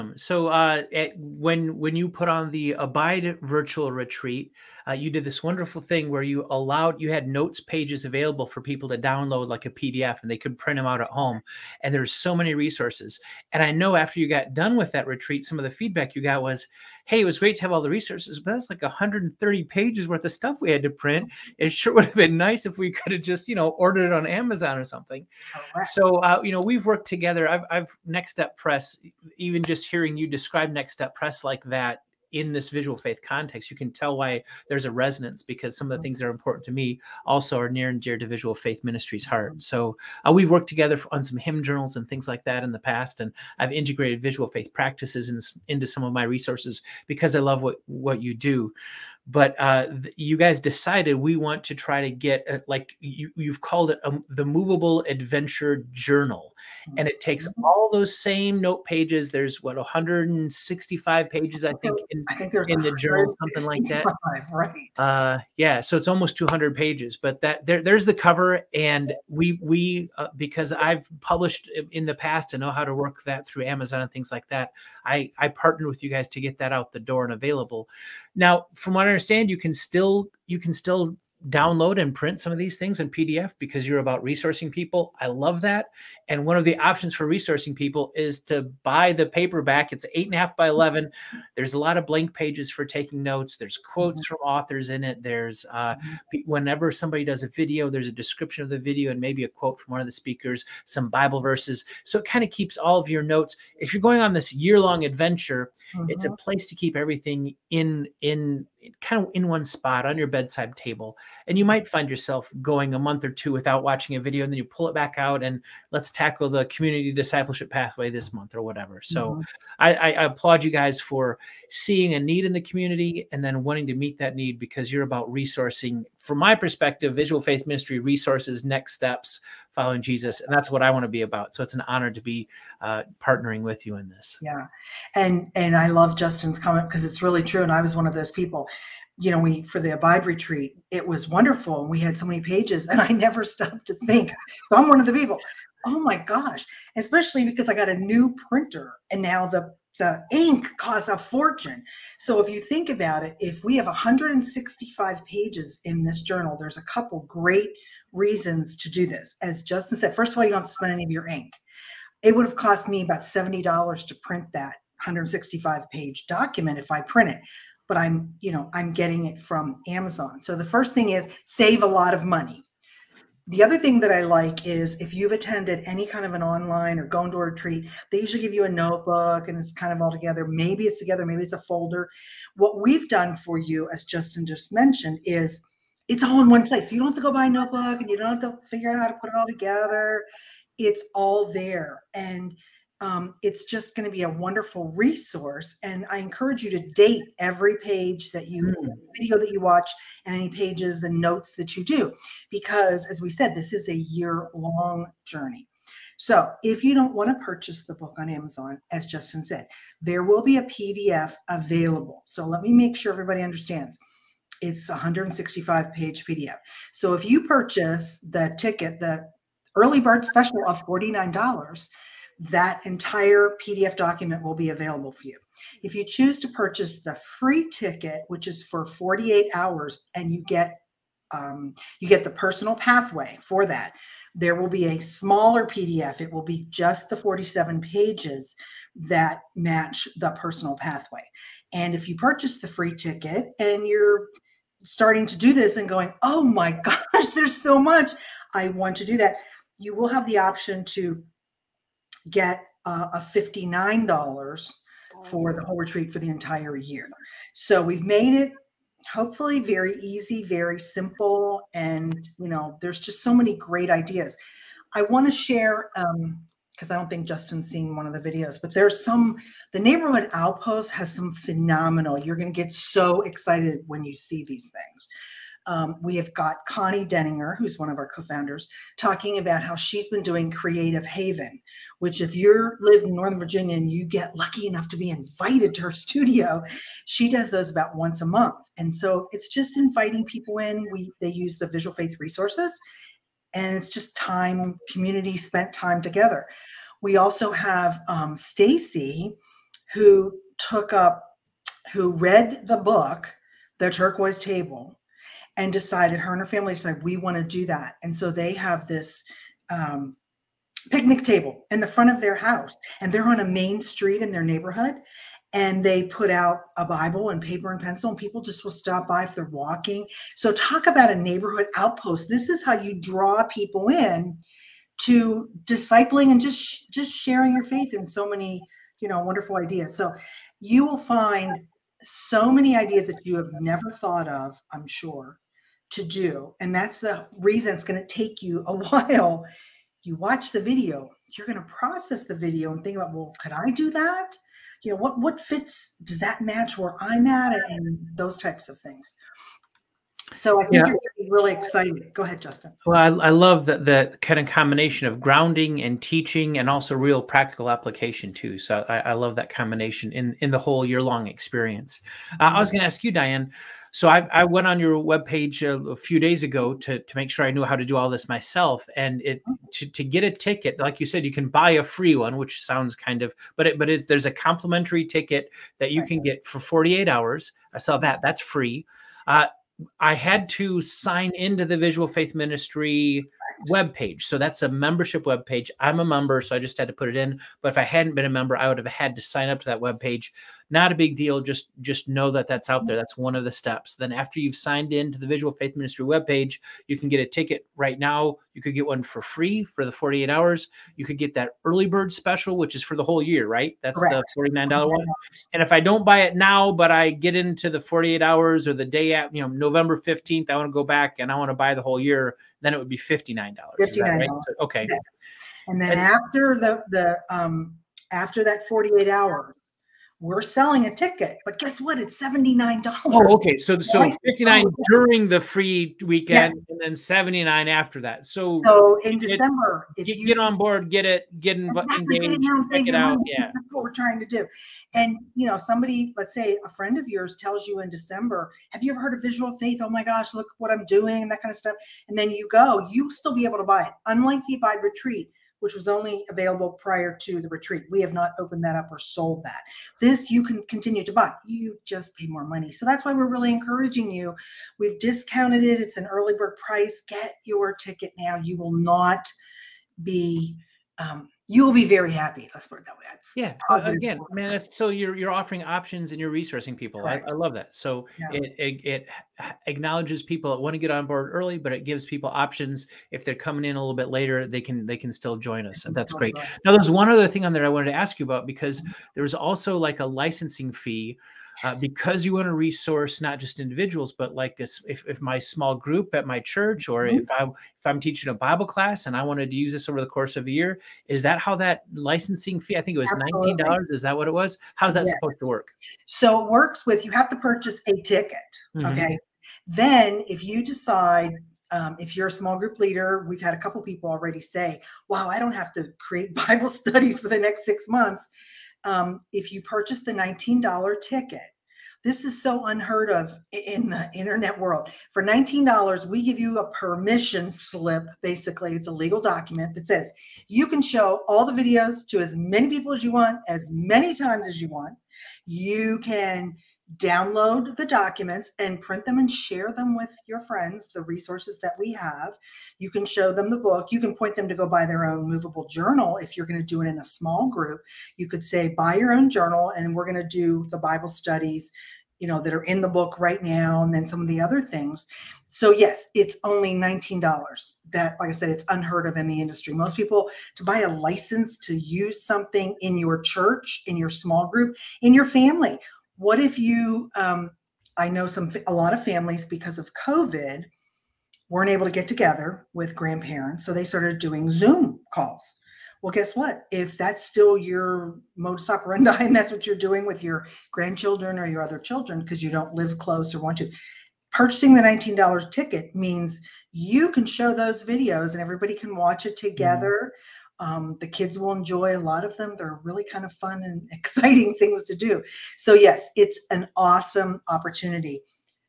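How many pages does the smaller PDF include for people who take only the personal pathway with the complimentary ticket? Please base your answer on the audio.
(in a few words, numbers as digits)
47.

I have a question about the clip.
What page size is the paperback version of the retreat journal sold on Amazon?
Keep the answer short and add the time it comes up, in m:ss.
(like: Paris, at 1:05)
8.5 by 11, at 1:30.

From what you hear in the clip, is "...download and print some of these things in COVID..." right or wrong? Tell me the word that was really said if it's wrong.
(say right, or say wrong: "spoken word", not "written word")
wrong: "PDF", not "COVID".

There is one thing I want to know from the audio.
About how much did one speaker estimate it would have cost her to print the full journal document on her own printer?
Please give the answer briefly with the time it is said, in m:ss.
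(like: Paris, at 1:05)
$70, at 2:43.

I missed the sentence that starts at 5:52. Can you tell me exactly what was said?
Well, I, I love that the kind of combination of grounding and teaching and also real practical application too.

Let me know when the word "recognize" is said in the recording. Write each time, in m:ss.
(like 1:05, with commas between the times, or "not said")
not said.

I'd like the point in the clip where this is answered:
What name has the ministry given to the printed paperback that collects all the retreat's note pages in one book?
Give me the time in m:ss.
0:54.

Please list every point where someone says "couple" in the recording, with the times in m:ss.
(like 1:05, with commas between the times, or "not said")
2:36, 8:23.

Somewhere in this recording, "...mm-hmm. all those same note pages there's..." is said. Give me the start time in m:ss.
0:57.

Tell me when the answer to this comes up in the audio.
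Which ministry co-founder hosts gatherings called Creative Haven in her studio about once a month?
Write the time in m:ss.
4:36.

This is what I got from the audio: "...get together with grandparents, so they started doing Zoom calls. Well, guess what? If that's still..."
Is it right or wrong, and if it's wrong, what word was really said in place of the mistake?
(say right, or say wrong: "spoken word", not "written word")
right.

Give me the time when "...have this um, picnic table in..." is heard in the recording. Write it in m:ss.
5:08.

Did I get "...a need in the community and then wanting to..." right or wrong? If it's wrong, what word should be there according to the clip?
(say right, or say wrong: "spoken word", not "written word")
right.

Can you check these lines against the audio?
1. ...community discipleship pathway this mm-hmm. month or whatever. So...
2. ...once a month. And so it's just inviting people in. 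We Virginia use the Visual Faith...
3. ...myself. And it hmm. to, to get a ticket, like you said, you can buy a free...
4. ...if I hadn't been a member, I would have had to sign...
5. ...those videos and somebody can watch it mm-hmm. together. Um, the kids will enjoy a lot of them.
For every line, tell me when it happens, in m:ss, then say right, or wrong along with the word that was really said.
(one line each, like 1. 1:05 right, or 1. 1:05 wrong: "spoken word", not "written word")
1. 1:56 right
2. 4:47 wrong: "They", not "Virginia"
3. 6:08 right
4. 6:27 right
5. 9:37 wrong: "everybody", not "somebody".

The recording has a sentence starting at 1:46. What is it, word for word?
place to keep everything in, in, kind of in one spot on your bedside table.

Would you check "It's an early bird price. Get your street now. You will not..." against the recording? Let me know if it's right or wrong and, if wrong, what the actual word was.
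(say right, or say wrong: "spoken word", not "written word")
wrong: "ticket", not "street".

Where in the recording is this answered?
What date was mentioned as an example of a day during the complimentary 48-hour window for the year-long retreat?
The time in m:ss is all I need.
6:49.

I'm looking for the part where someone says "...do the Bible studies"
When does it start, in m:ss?
9:00.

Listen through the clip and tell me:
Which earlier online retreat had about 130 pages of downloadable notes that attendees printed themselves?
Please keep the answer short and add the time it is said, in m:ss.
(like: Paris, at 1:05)
Abide virtual retreat, at 0:02.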